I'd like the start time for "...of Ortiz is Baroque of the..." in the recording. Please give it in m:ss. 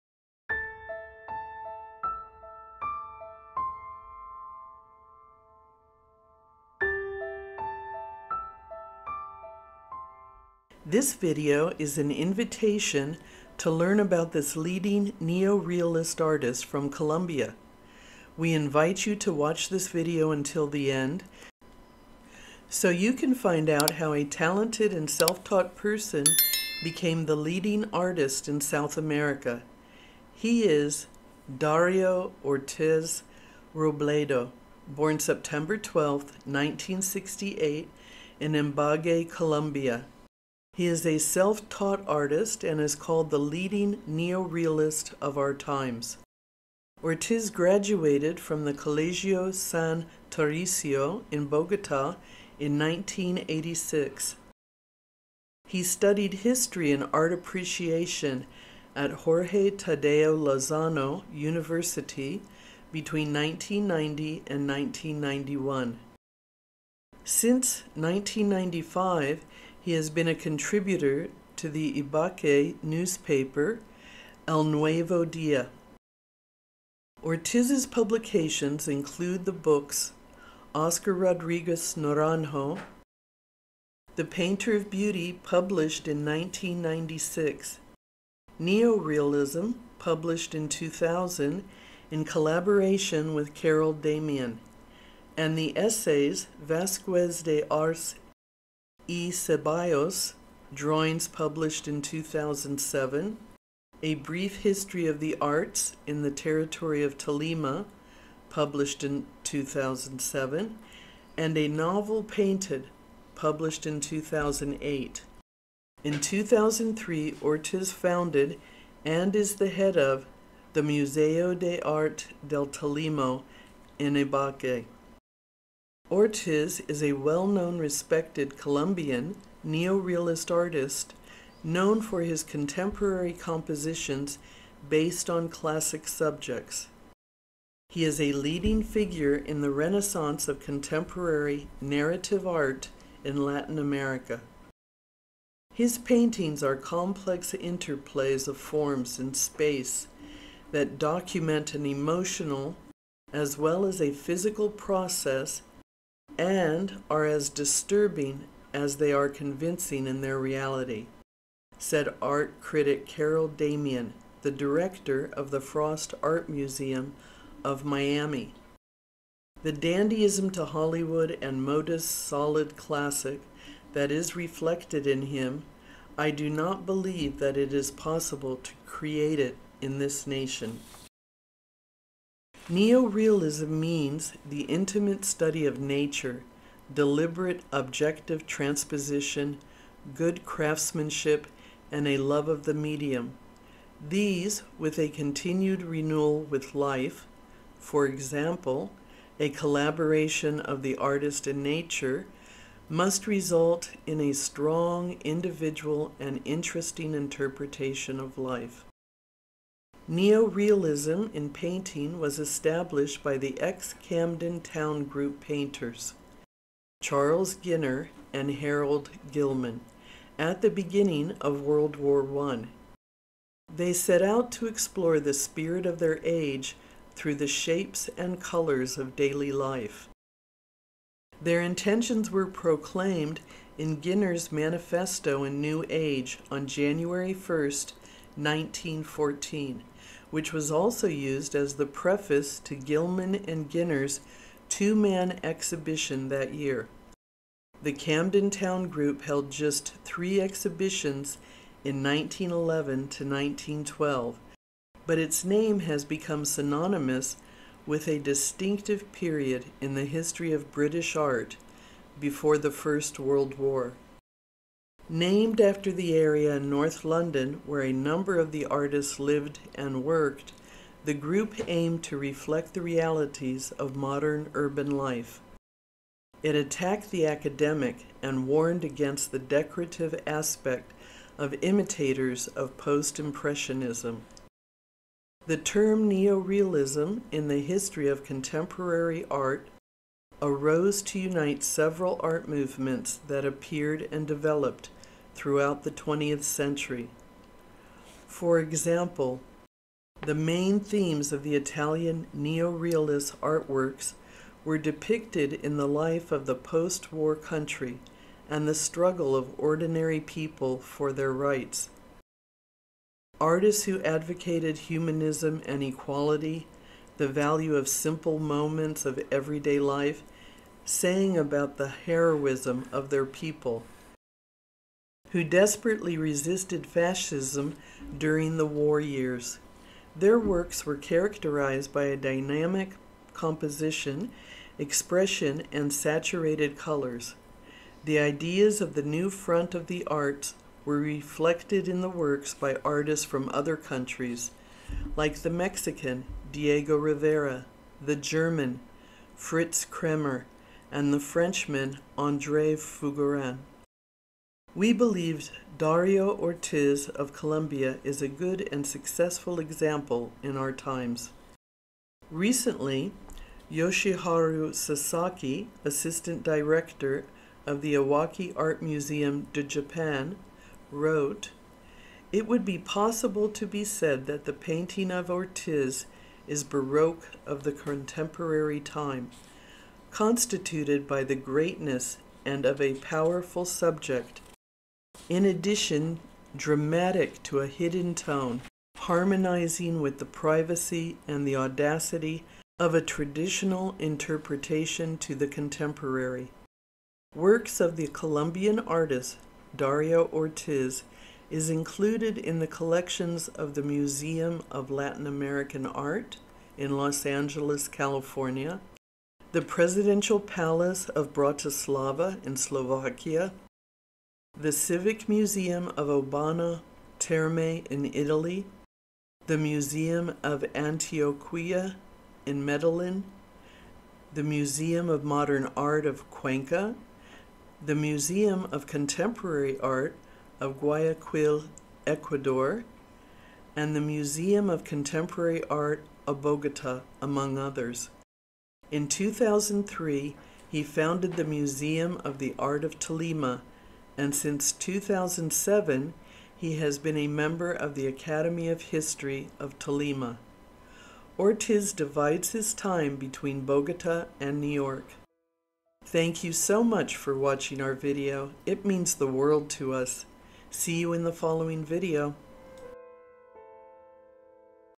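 6:15.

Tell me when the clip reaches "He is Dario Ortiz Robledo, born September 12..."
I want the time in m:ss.
0:30.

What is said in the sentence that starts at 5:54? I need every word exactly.
We believe Dario Ortiz of Colombia is a good and successful example in our times.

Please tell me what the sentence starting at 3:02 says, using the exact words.
Neorealism means the intimate study of nature, deliberate objective transposition, good craftsmanship, and a love of the medium.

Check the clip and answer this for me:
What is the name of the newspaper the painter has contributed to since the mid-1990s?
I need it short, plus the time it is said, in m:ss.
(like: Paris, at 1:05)
El Nuevo Dia, at 1:14.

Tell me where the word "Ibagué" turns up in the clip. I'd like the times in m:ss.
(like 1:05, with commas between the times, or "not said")
0:38, 1:12, 2:04.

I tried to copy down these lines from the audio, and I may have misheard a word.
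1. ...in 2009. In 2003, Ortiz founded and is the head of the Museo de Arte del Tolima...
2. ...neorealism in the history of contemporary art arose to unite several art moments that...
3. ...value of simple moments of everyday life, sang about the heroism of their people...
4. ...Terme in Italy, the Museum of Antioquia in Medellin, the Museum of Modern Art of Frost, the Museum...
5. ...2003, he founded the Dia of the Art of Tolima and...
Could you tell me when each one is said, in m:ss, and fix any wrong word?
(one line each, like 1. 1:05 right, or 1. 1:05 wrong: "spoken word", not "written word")
1. 1:53 wrong: "2008", not "2009"
2. 4:46 wrong: "movements", not "moments"
3. 5:17 right
4. 6:57 wrong: "Cuenca", not "Frost"
5. 7:19 wrong: "Museum", not "Dia".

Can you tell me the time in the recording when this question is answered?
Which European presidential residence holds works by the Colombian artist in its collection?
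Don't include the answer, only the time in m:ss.
6:49.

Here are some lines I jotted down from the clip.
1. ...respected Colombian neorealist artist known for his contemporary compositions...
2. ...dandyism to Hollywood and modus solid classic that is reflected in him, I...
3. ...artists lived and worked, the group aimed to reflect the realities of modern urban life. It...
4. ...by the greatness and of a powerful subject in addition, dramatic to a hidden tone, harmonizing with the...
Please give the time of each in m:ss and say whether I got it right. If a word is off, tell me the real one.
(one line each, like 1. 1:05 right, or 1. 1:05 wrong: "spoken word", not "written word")
1. 2:07 right
2. 2:49 right
3. 4:28 right
4. 6:21 right.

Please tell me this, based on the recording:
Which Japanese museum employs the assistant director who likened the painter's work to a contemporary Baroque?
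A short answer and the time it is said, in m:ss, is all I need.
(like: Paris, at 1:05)
Iwaki Art Museum, at 6:07.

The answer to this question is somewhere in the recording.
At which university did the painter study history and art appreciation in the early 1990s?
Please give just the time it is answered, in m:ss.
0:59.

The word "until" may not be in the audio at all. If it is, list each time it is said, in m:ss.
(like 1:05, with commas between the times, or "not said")
0:20.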